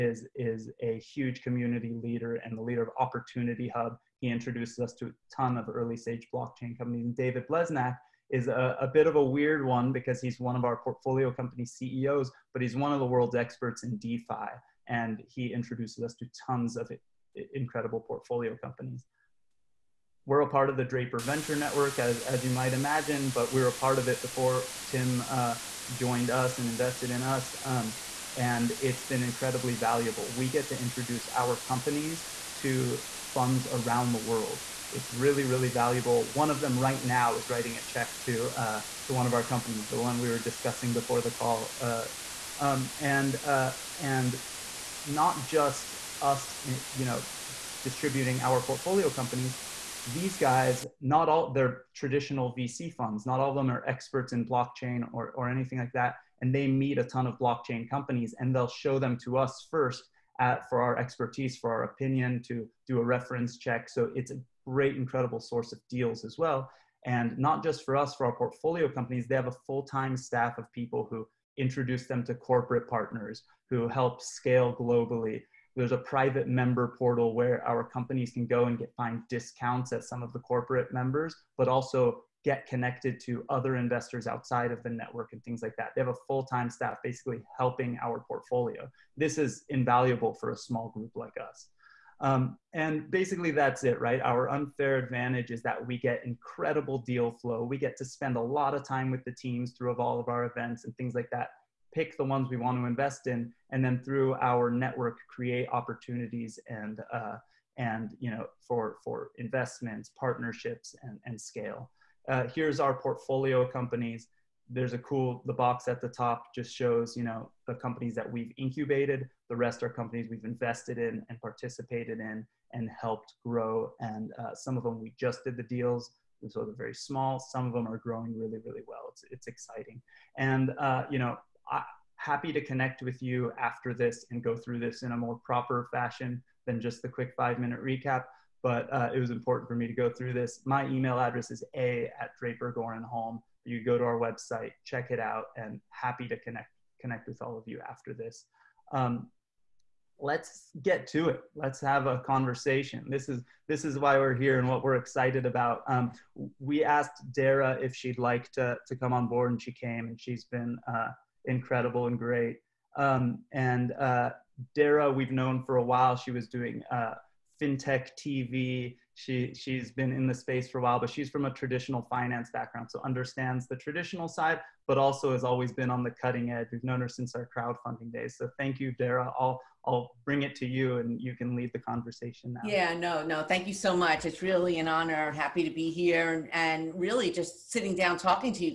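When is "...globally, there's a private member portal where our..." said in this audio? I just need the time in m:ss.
1:14.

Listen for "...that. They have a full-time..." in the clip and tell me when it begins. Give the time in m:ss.
1:25.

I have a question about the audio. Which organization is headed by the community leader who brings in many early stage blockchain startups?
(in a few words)
Opportunity Hub.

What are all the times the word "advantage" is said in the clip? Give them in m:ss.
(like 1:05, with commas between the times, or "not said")
1:34.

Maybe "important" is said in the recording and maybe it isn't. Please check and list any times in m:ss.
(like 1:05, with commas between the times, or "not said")
2:19.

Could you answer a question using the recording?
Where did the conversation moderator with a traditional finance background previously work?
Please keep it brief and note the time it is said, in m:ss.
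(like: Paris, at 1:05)
FinTech TV, at 2:47.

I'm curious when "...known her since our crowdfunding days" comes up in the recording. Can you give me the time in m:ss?
2:56.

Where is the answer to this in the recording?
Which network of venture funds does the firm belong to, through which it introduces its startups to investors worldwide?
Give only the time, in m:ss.
0:20.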